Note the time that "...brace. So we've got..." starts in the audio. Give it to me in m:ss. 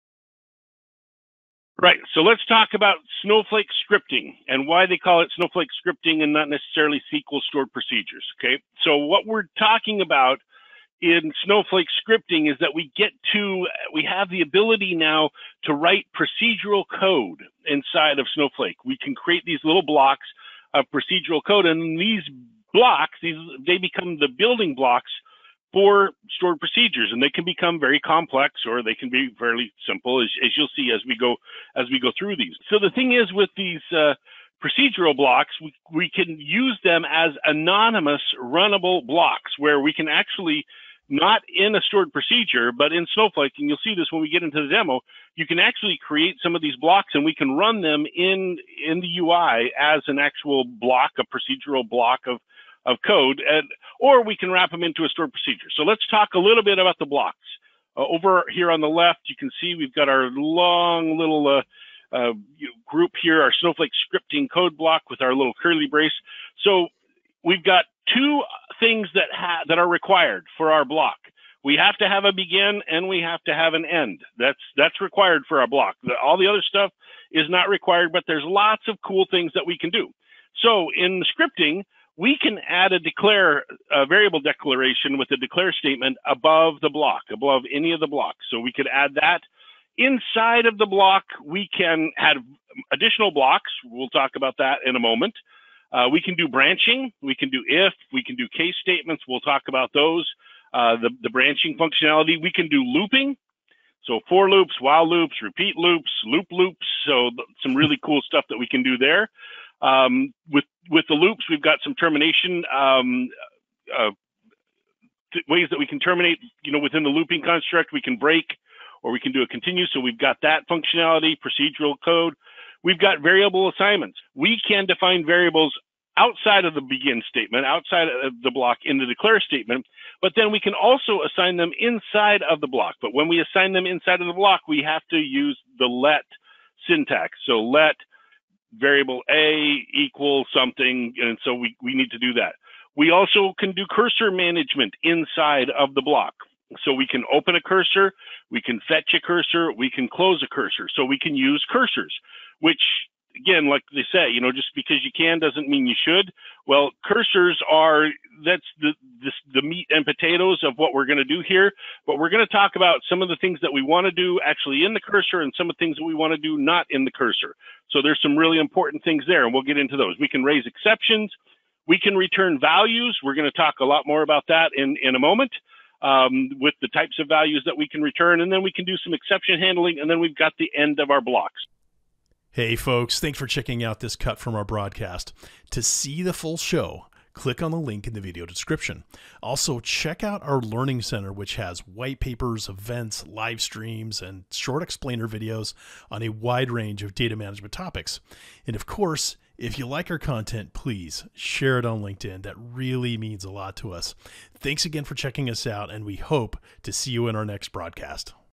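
1:05.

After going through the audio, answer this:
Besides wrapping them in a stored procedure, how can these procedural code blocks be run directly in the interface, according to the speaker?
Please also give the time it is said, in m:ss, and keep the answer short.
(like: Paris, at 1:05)
Anonymous runnable blocks, at 0:37.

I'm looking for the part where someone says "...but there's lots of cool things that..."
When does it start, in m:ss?
1:18.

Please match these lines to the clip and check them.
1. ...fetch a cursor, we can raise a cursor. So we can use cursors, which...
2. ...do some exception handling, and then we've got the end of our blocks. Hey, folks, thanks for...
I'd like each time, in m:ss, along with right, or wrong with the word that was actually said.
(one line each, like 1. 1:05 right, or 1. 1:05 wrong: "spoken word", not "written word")
1. 2:28 wrong: "close", not "raise"
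2. 2:58 right.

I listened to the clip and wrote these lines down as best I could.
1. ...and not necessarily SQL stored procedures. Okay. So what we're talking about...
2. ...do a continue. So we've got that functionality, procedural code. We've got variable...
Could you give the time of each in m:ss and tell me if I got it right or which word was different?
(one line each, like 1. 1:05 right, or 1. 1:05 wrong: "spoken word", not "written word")
1. 0:06 right
2. 1:59 right.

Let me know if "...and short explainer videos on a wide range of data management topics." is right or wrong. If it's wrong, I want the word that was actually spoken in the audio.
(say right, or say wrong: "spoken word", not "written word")
right.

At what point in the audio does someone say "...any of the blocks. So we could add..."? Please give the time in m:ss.
1:27.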